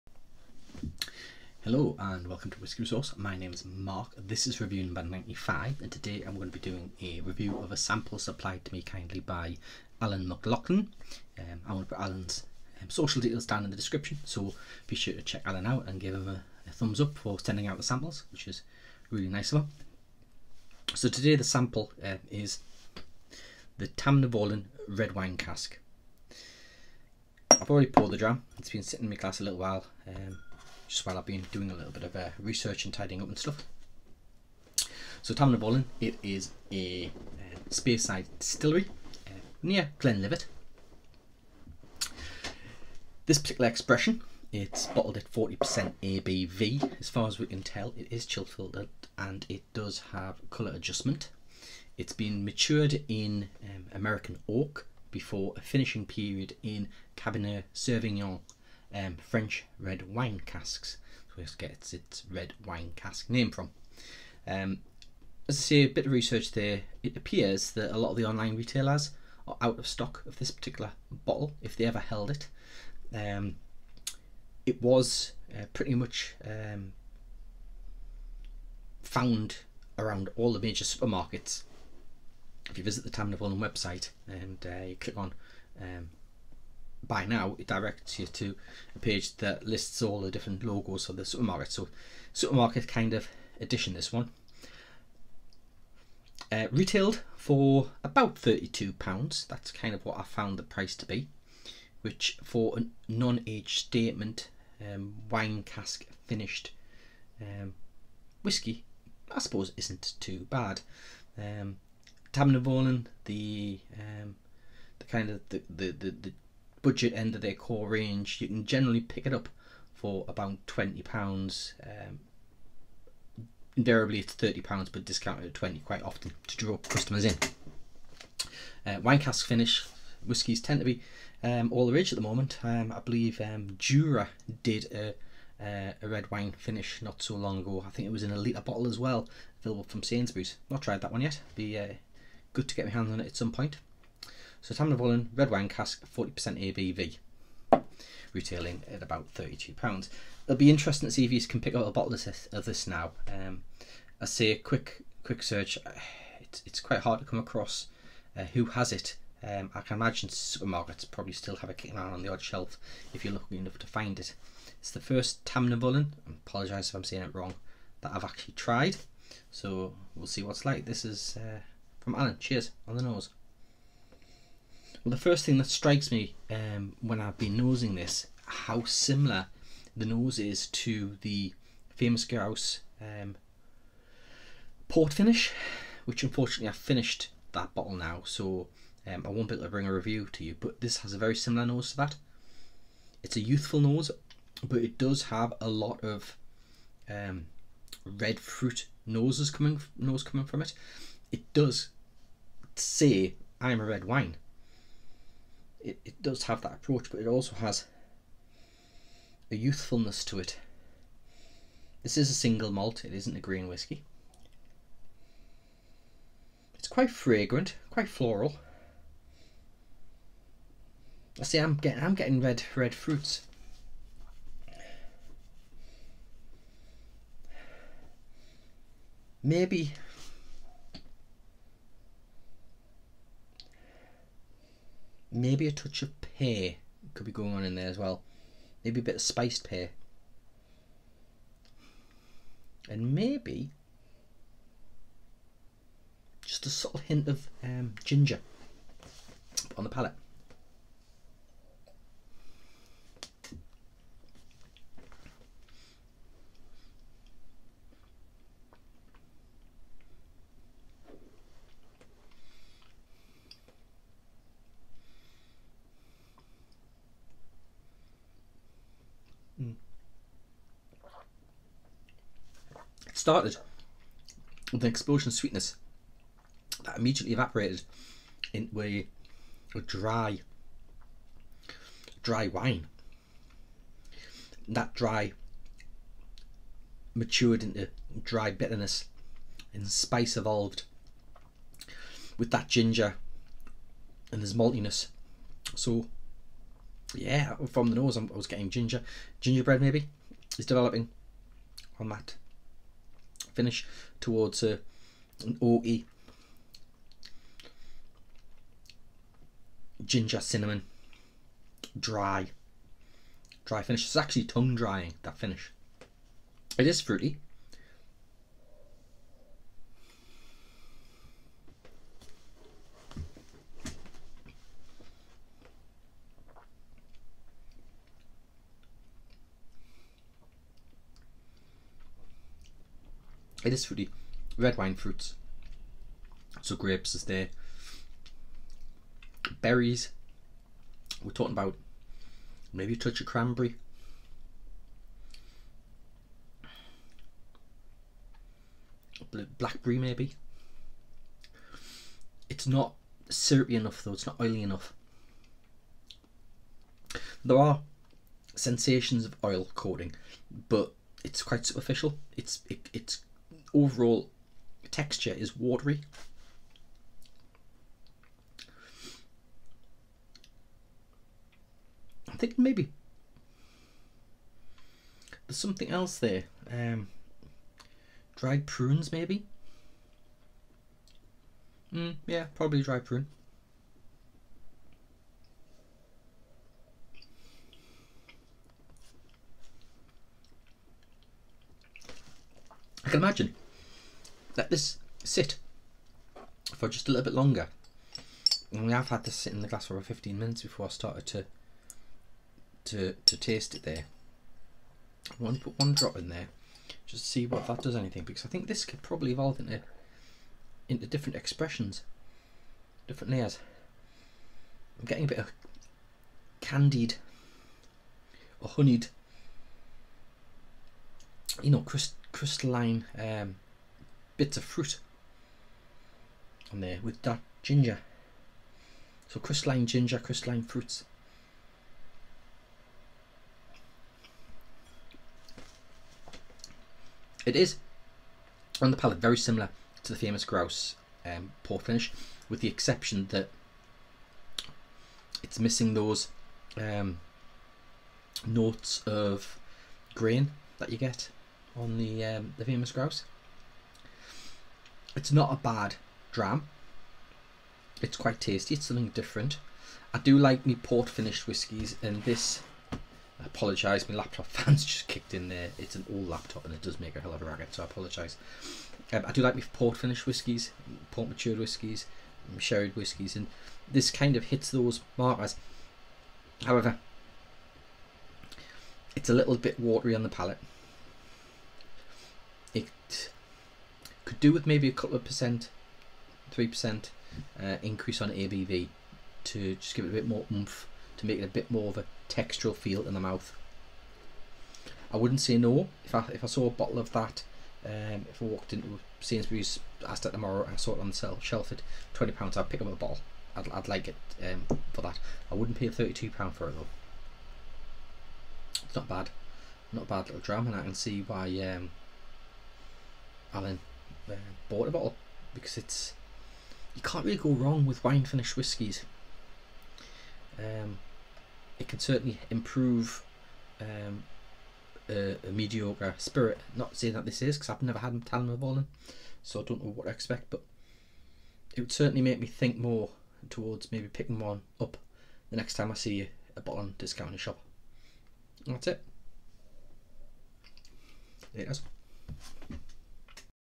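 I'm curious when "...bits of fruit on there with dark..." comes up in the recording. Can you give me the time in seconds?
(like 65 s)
424 s.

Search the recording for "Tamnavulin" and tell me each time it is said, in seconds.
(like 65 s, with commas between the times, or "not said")
23 s, 35 s, 83 s, 144 s, 165 s.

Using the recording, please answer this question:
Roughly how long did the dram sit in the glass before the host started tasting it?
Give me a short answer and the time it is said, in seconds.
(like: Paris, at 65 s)
15 minutes, at 400 s.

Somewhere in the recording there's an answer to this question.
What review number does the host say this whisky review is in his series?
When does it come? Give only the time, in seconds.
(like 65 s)
5 s.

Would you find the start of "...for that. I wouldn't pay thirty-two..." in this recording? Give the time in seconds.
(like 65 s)
504 s.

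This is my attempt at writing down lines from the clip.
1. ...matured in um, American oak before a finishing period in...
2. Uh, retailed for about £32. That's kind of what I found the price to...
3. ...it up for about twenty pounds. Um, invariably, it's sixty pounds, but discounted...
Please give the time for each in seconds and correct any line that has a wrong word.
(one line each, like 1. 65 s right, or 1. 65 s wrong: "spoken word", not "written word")
1. 52 s right
2. 96 s right
3. 119 s wrong: "thirty", not "sixty".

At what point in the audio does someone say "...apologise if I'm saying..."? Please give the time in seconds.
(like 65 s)
166 s.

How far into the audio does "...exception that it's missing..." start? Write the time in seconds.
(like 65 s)
442 s.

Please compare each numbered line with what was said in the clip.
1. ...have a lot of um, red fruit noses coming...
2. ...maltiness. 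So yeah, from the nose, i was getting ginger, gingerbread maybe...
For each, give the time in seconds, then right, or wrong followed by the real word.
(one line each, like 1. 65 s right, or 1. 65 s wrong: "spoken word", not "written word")
1. 195 s right
2. 294 s right.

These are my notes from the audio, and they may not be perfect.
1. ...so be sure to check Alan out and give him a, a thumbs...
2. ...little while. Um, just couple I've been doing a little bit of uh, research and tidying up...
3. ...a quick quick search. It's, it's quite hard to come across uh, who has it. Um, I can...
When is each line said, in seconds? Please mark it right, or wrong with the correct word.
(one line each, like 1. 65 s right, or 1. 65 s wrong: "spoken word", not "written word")
1. 14 s right
2. 29 s wrong: "while", not "couple"
3. 154 s right.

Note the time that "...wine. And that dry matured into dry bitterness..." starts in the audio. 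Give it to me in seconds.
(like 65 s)
282 s.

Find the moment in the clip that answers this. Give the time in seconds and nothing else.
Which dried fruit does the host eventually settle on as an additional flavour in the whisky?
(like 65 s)
383 s.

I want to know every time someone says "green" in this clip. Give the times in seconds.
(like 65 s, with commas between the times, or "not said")
213 s.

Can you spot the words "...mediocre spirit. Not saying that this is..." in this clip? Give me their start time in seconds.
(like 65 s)
525 s.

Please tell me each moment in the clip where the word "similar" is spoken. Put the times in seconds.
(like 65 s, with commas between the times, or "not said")
178 s, 191 s, 439 s.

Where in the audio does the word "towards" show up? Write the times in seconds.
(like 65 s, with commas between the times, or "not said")
304 s, 533 s.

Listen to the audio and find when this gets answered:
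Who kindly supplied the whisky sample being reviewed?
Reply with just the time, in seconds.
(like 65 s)
10 s.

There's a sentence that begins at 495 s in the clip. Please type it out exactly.
I wouldn't say no if I if I saw a bottle of that.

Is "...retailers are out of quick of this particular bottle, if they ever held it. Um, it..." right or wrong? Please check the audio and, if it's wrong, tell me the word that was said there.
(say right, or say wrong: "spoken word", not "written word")
wrong: "stock", not "quick".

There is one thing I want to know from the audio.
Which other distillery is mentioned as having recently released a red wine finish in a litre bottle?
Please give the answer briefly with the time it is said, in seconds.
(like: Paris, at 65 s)
Jura, at 133 s.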